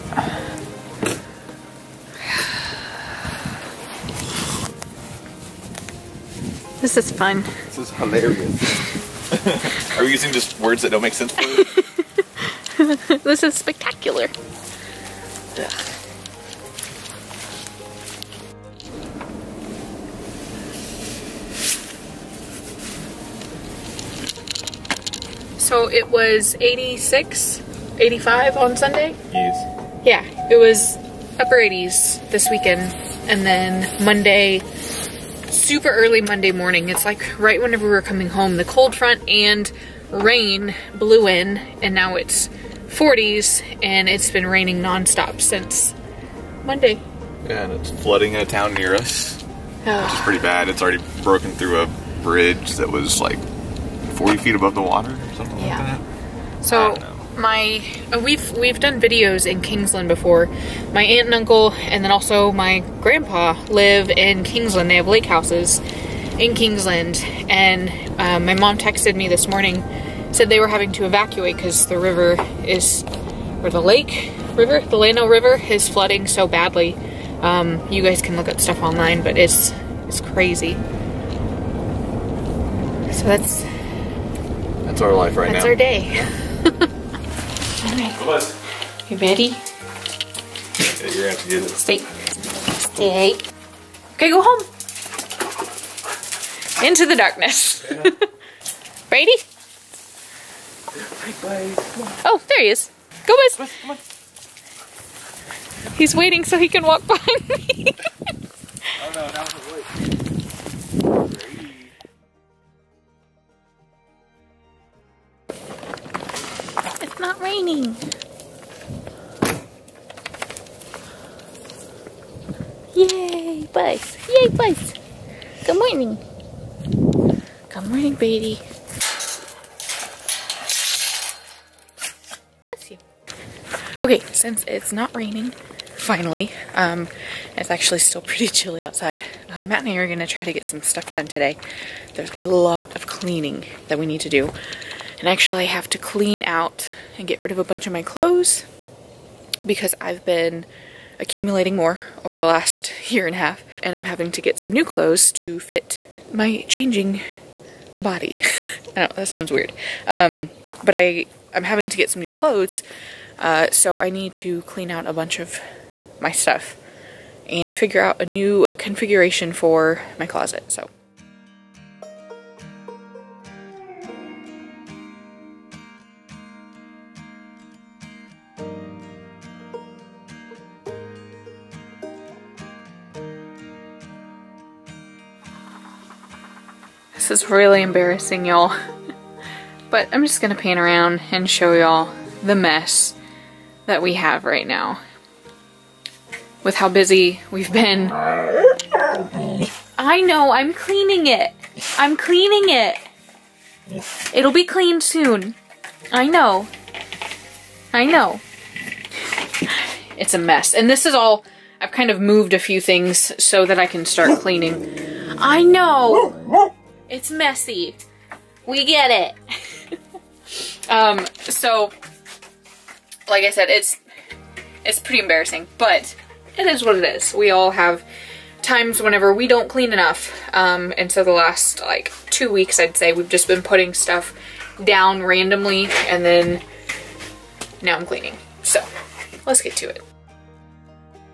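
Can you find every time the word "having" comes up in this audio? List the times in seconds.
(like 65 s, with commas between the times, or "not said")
70 s, 154 s, 161 s.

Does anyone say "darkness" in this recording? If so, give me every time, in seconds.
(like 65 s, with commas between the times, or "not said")
97 s.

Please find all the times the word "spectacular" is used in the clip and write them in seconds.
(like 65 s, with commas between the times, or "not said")
13 s.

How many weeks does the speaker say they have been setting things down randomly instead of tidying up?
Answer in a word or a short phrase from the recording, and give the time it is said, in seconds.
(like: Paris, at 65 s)
2, at 232 s.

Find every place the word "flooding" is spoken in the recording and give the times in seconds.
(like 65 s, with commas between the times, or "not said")
48 s, 75 s.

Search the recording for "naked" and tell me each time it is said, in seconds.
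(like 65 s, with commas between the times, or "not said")
not said.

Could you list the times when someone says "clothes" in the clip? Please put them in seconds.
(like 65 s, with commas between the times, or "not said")
148 s, 154 s, 162 s.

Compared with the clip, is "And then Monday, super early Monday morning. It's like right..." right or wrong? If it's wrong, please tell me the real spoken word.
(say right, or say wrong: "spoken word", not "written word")
right.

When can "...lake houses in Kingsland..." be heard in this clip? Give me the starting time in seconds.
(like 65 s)
65 s.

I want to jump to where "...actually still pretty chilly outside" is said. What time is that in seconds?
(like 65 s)
137 s.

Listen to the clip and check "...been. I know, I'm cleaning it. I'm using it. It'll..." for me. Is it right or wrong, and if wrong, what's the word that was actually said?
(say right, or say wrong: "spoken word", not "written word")
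wrong: "cleaning", not "using".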